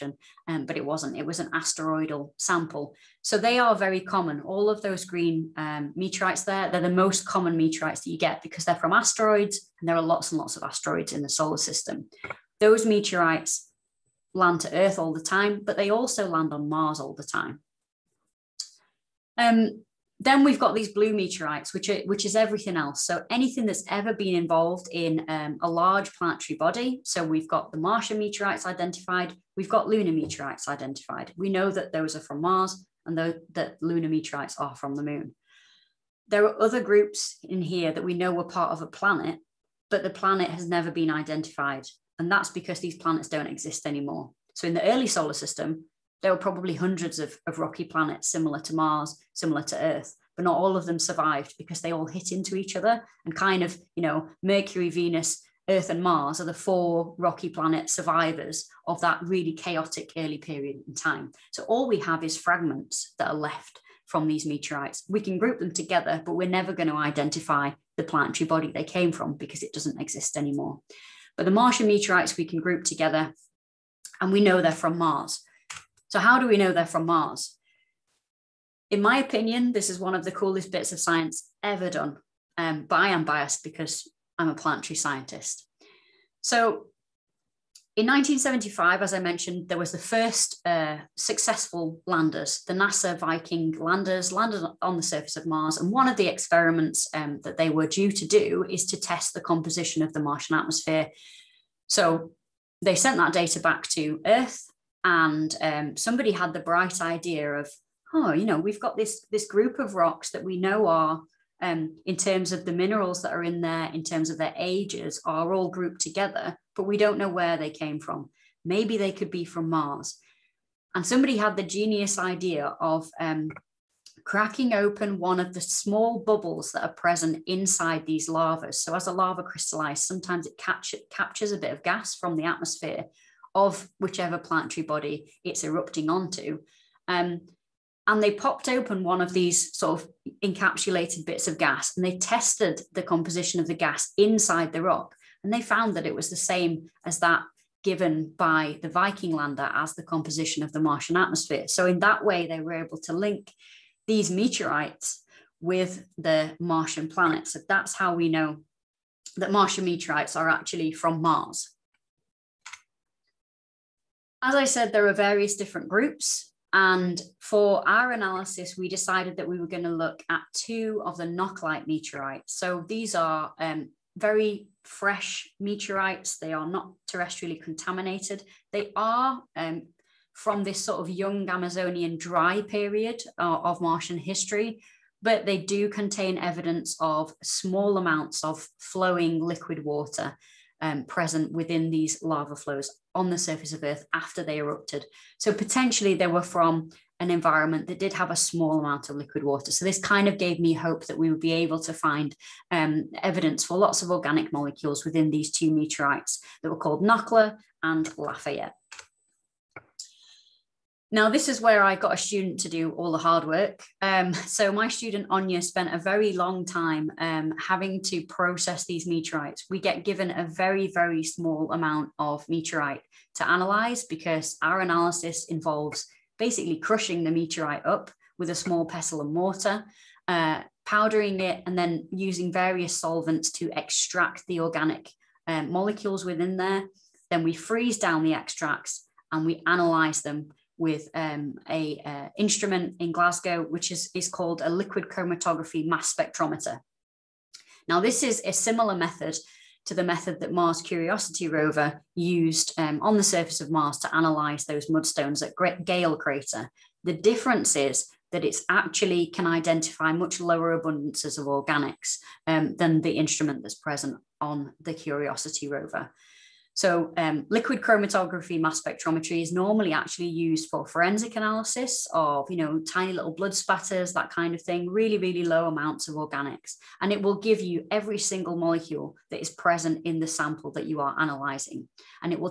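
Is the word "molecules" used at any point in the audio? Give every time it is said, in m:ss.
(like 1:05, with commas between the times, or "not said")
3:24, 3:55, 4:38.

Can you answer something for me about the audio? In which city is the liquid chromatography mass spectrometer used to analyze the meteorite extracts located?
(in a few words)
Glasgow.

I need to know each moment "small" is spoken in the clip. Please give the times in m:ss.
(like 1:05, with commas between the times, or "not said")
2:05, 3:07, 3:18, 3:41, 3:48.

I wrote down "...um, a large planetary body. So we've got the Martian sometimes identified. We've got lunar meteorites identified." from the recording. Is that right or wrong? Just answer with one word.
wrong.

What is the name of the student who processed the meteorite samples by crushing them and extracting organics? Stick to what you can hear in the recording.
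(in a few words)
Anya.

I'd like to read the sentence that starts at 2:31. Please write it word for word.
So, in that way, they were able to link these meteorites with the Martian planets.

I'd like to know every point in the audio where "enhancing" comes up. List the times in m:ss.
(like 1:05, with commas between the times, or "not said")
not said.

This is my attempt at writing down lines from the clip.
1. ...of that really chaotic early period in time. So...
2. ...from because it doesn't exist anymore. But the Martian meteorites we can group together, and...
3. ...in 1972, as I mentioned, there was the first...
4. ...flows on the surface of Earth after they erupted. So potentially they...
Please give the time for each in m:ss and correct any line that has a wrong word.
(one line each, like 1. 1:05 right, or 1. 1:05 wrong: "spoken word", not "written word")
1. 0:58 right
2. 1:09 right
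3. 1:27 wrong: "1975", not "1972"
4. 3:12 right.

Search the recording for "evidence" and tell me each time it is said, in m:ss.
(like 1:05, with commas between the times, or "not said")
3:06, 3:23.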